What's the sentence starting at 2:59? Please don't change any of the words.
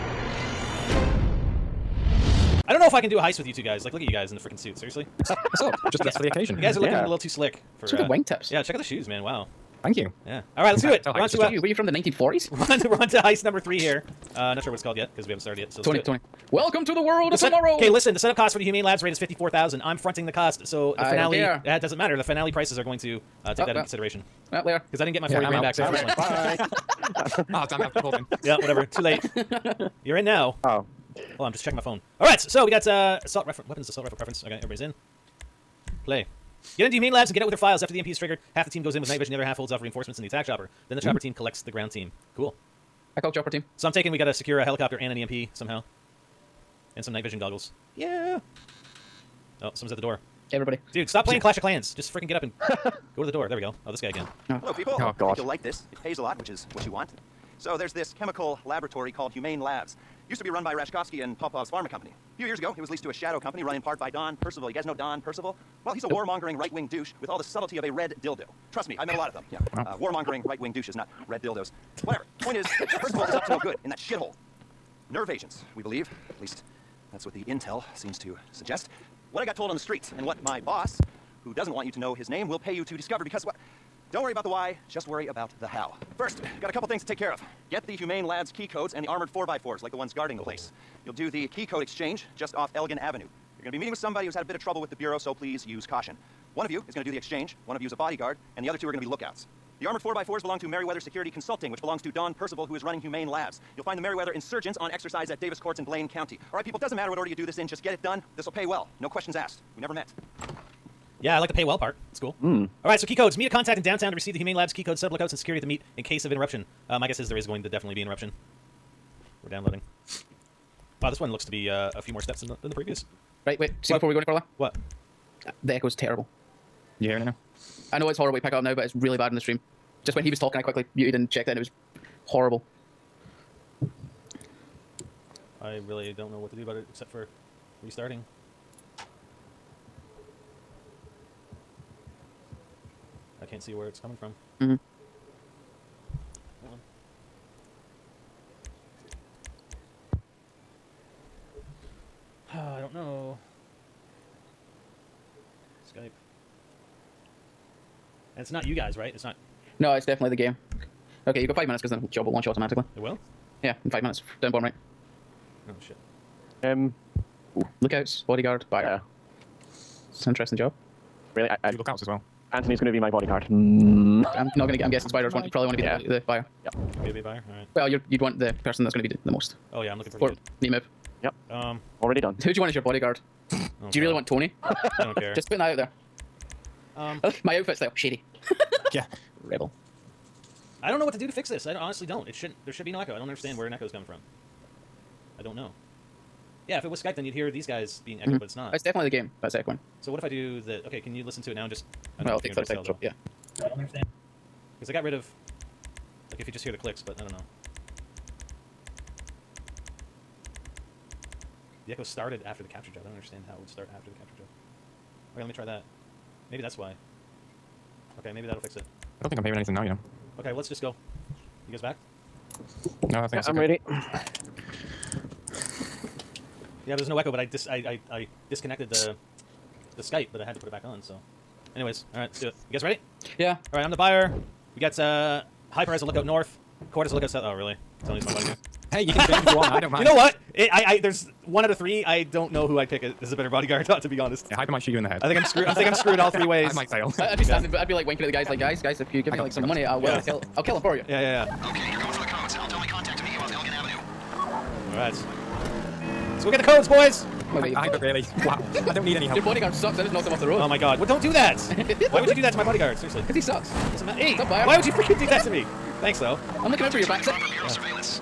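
Oh yeah, I'm looking pretty or, good.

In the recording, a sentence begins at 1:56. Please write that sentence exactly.
Uh, my guess is there is going to definitely be interruption.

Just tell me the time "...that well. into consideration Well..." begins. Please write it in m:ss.
0:23.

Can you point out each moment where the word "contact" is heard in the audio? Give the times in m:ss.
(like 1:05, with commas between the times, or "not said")
1:53, 4:12.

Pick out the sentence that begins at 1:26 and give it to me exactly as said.
First, got a couple things to take care of.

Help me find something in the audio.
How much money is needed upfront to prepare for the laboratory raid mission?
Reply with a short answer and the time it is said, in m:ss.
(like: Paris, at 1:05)
$54,000, at 0:19.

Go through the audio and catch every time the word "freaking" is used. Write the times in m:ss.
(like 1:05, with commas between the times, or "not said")
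0:04, 0:52, 4:24.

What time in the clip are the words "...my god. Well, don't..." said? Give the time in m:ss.
4:20.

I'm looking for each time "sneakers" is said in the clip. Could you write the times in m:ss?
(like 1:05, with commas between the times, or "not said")
not said.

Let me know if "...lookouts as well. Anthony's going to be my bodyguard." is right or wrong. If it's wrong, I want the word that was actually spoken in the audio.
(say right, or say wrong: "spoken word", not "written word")
right.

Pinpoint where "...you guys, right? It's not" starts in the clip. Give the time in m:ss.
2:38.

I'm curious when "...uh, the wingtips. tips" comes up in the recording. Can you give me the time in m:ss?
0:07.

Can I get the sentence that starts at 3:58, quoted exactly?
Hey, you can change if you want.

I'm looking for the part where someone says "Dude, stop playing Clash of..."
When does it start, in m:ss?
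0:50.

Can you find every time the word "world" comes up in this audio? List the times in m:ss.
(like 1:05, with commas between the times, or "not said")
0:17.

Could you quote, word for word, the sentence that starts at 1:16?
At least that's what the intel seems to suggest.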